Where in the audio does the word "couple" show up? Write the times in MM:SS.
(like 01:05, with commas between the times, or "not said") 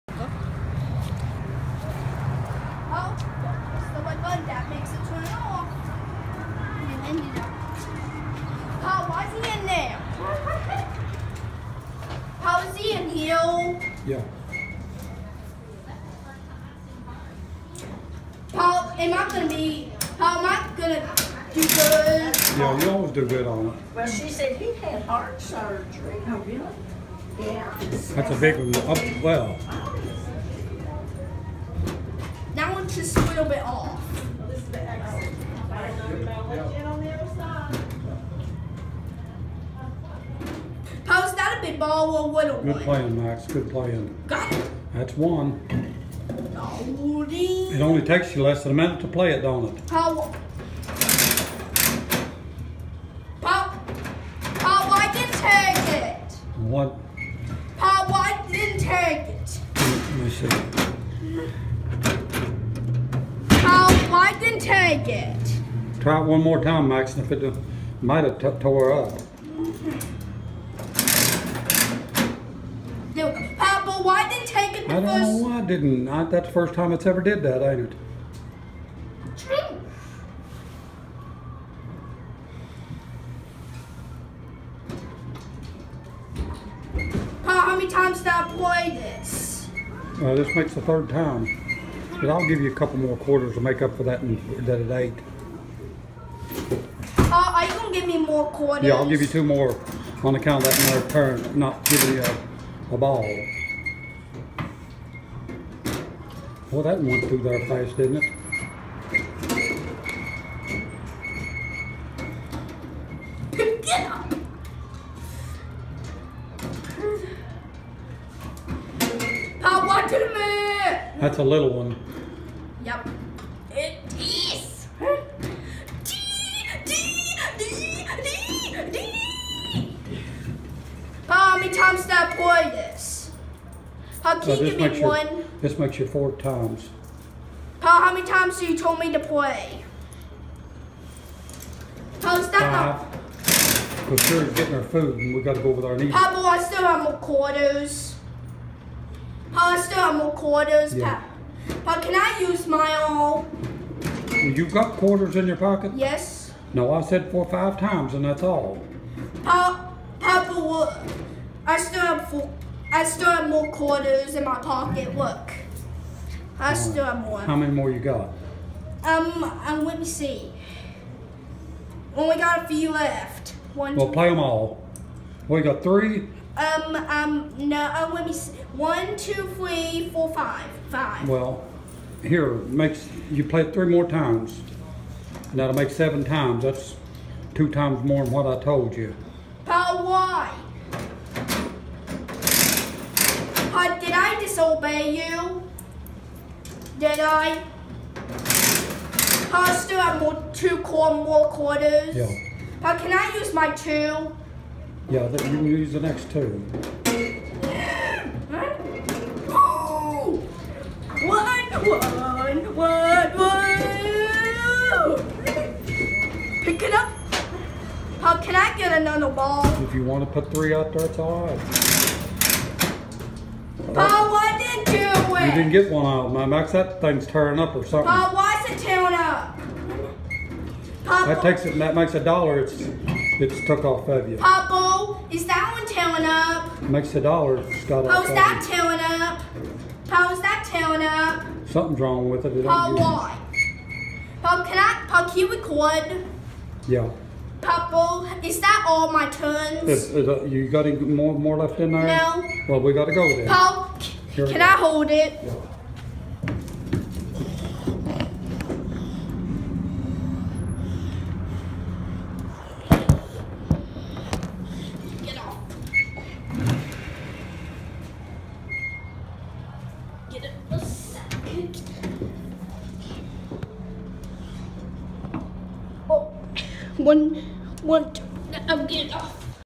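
01:32.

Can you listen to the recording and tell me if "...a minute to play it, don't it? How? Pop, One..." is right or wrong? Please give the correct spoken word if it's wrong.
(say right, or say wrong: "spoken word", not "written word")
wrong: "Pop", not "One".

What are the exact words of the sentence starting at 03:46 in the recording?
That thing's tearing up or something.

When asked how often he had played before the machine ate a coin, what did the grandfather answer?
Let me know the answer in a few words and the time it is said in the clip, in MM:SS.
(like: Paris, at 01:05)
third time, at 01:30.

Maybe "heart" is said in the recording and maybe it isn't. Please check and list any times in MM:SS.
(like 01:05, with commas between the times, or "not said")
00:25.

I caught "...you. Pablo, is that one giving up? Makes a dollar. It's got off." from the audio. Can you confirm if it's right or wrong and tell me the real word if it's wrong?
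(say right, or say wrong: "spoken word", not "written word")
wrong: "tearing", not "giving".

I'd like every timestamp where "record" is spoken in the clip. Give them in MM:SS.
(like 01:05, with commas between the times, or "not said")
04:05.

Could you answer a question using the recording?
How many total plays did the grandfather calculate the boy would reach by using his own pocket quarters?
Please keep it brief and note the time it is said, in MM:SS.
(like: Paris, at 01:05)
7, at 03:05.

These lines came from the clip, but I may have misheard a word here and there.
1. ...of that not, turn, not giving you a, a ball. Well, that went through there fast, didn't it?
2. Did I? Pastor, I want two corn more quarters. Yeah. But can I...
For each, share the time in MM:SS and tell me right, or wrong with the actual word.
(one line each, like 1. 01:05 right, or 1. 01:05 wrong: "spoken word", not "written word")
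1. 01:40 right
2. 03:16 right.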